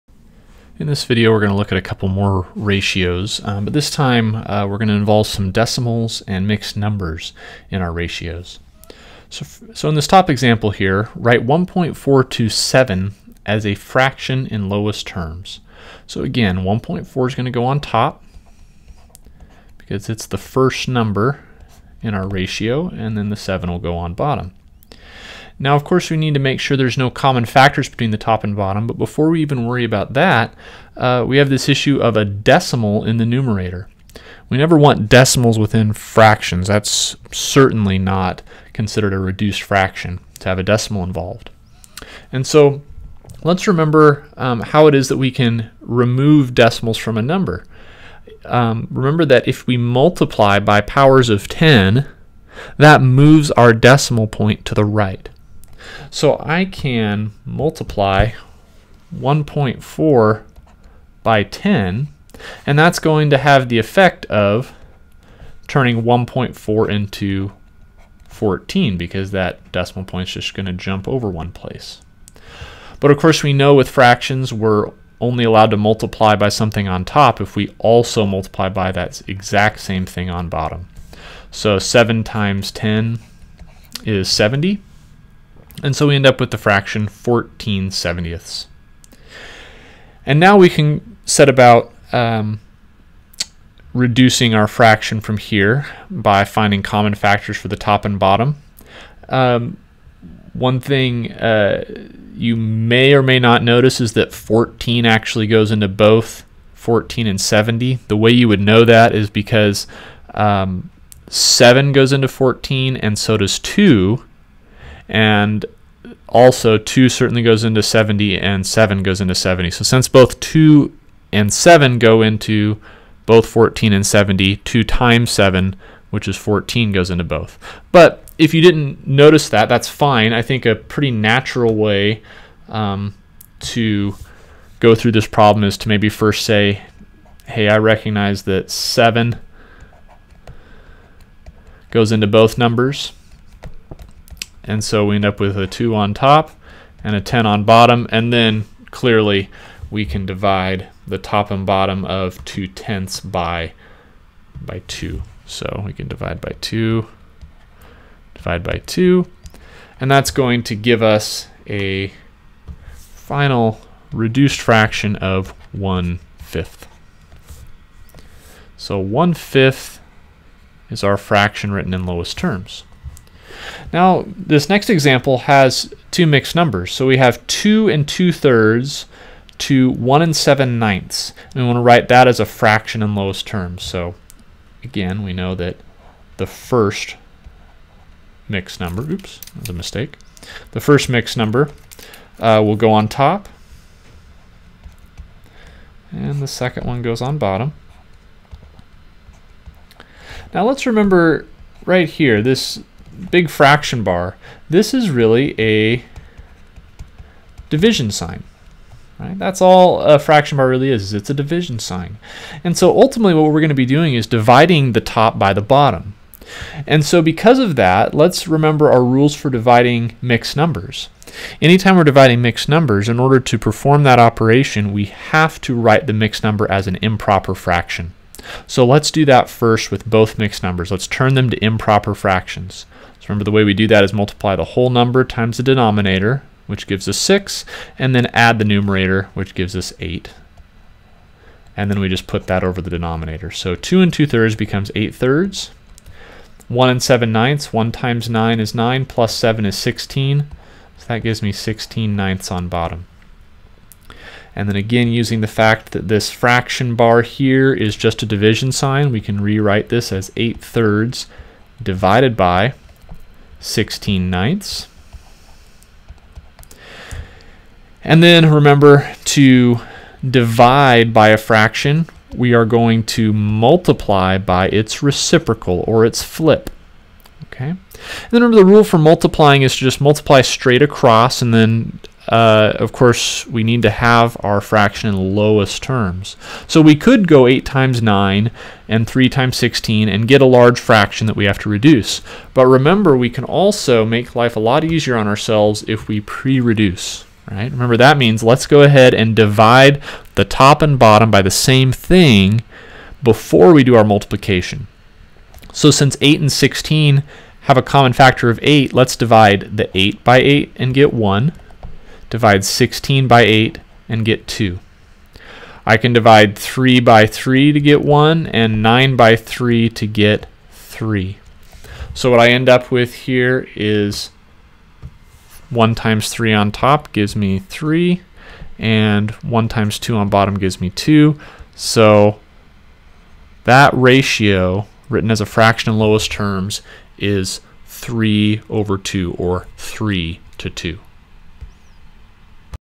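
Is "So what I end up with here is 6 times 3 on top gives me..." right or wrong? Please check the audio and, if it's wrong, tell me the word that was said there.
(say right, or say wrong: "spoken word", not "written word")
wrong: "1", not "6".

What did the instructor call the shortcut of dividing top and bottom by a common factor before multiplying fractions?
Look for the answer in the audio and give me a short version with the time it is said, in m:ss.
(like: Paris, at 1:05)
pre-reduce, at 4:56.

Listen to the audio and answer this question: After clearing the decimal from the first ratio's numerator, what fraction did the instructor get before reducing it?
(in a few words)
14/70.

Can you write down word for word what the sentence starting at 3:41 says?
Anytime we're dividing mixed numbers, in order to perform that operation, we have to write the mixed number as an improper fraction.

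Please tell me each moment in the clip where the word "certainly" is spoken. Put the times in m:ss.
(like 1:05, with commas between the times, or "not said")
0:37, 1:57.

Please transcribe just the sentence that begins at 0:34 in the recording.
We never want decimals within fractions.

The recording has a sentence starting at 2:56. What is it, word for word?
So we have 2 and 2 thirds to 1 and 7 ninths.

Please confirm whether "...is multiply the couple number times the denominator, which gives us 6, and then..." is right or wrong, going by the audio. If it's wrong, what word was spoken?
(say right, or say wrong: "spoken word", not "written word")
wrong: "whole", not "couple".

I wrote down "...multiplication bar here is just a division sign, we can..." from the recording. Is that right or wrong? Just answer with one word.
wrong.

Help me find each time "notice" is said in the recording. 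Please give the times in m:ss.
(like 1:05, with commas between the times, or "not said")
1:43, 2:09.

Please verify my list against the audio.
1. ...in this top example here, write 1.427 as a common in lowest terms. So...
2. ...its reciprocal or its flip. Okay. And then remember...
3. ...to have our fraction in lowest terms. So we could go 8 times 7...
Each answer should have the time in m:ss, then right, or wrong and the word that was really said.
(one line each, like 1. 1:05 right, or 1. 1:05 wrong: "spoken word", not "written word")
1. 0:09 wrong: "fraction", not "common"
2. 4:34 right
3. 4:43 wrong: "9", not "7".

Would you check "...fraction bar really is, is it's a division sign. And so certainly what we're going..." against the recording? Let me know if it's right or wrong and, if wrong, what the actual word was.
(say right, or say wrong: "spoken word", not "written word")
wrong: "ultimately", not "certainly".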